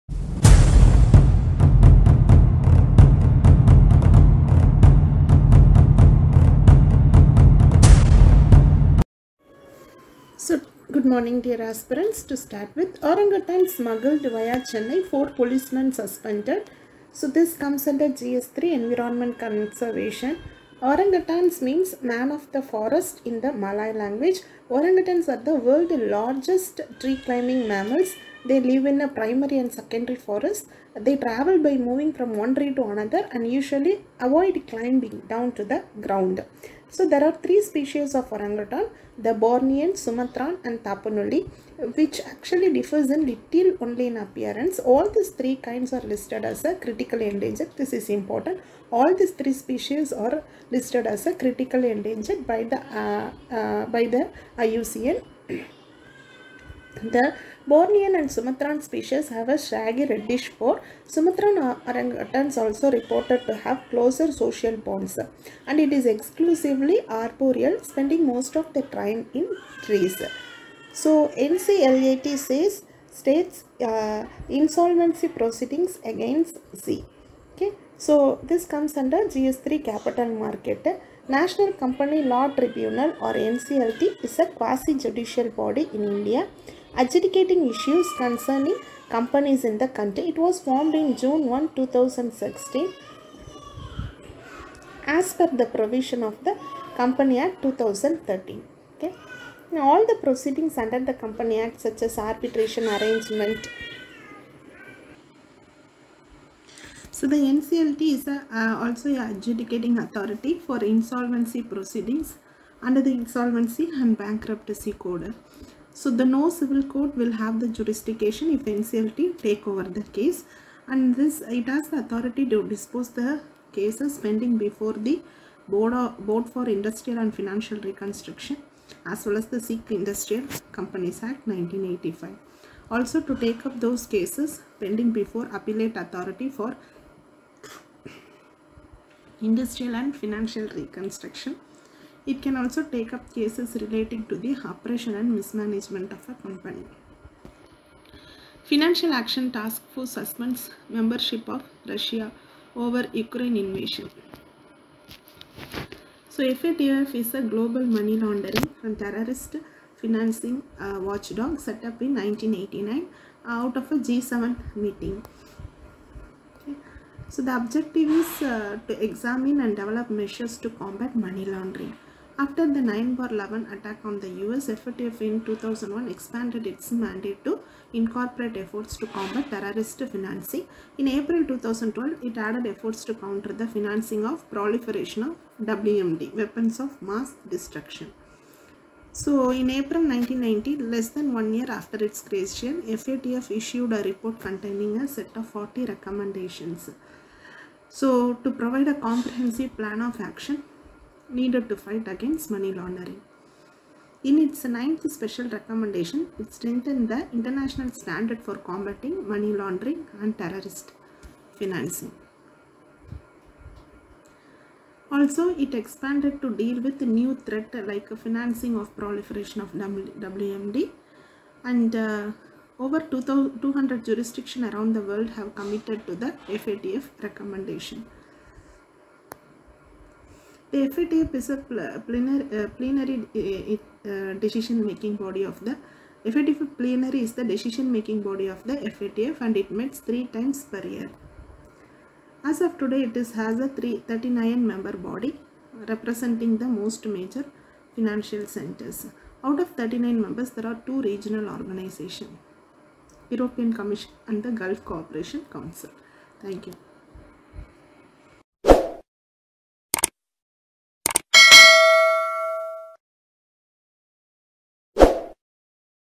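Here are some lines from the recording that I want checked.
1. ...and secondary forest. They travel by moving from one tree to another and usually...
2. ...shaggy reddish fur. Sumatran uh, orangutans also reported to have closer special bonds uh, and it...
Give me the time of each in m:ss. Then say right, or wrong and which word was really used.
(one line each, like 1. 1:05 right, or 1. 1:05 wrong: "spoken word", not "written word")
1. 0:29 right
2. 0:59 wrong: "social", not "special".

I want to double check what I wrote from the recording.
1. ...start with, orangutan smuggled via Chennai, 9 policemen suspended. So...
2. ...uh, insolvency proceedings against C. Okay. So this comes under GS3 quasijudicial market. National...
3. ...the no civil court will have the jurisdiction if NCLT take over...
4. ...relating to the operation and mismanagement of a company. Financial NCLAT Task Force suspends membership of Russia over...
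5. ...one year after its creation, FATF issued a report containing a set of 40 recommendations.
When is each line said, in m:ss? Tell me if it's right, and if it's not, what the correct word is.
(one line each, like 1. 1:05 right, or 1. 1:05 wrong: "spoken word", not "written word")
1. 0:12 wrong: "4", not "9"
2. 1:13 wrong: "capital", not "quasijudicial"
3. 1:56 right
4. 2:23 wrong: "Action", not "NCLAT"
5. 3:11 right.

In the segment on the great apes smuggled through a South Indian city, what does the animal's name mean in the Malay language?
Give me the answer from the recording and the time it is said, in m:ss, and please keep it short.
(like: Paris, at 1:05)
Man of the forest, at 0:22.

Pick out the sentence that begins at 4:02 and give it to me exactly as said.
As of today it is has a 39 member body representing the most major financial centers.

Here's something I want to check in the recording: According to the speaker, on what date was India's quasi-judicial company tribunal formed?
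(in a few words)
June 1, 2016.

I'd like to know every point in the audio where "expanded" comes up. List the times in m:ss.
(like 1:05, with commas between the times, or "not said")
2:56, 3:35.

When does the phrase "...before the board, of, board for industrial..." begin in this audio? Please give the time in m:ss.
2:04.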